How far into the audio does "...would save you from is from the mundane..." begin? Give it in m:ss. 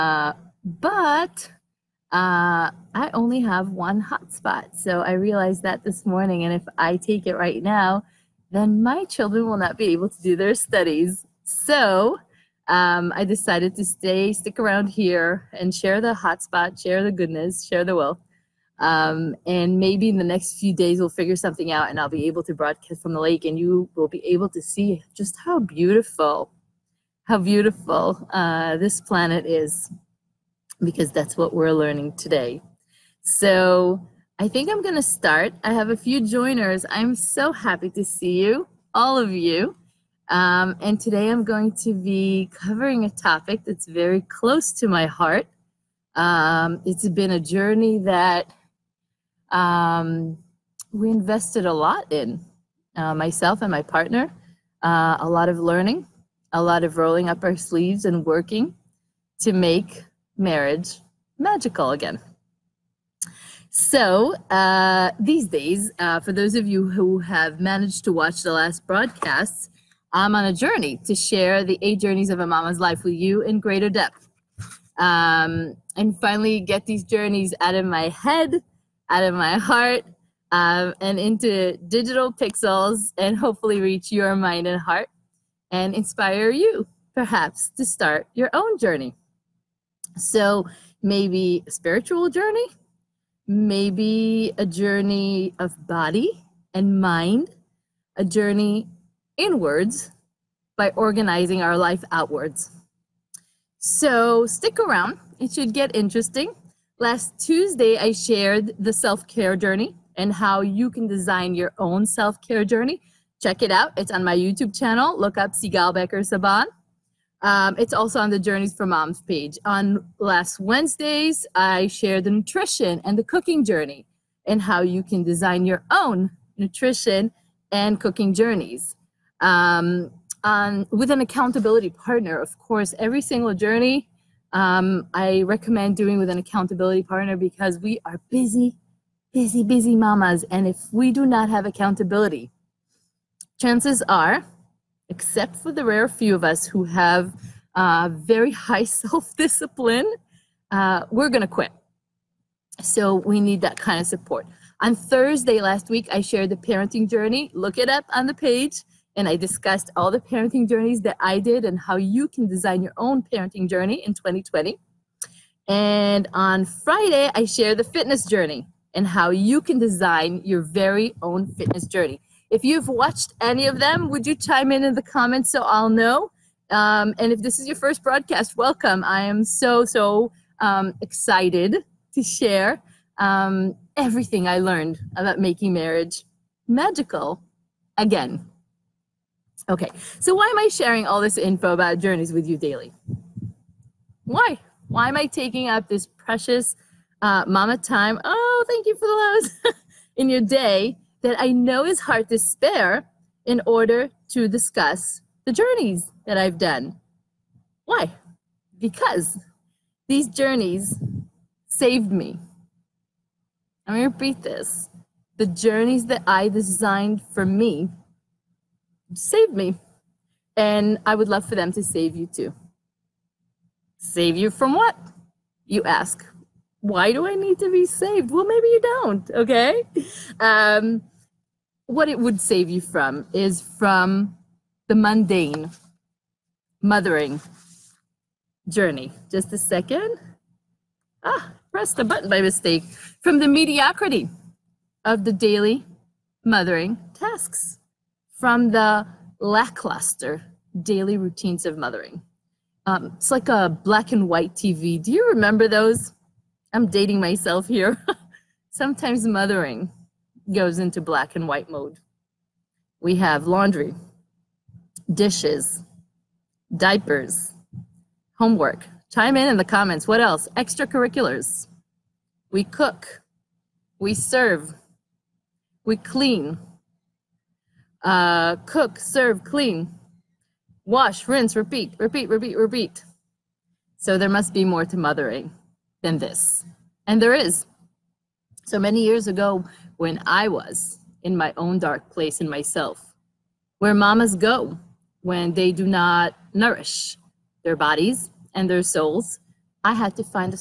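3:52.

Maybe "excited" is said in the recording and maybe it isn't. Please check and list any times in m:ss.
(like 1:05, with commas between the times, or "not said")
3:01.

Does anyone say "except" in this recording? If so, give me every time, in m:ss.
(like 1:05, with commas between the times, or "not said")
2:25.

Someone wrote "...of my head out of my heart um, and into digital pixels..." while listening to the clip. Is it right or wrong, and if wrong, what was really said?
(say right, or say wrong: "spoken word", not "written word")
right.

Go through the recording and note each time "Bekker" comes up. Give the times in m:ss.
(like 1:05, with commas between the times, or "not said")
1:55.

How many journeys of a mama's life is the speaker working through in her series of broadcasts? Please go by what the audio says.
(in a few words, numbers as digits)
8.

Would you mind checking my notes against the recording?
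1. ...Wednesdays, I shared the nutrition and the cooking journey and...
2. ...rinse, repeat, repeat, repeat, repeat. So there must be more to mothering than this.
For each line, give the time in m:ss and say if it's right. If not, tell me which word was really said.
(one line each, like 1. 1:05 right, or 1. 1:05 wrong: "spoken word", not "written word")
1. 2:00 right
2. 4:41 right.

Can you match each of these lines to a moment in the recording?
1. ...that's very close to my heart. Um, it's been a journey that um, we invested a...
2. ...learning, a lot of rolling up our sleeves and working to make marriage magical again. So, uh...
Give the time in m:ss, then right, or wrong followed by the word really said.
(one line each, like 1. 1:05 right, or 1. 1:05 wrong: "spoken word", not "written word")
1. 0:43 right
2. 0:55 right.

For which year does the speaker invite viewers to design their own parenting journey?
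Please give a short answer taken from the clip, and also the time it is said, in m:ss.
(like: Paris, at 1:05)
2020, at 2:44.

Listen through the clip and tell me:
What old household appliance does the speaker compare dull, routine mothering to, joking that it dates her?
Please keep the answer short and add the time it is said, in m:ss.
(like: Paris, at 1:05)
black and white TV, at 4:13.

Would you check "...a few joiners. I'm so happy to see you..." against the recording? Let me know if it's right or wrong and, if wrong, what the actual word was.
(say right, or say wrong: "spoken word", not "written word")
right.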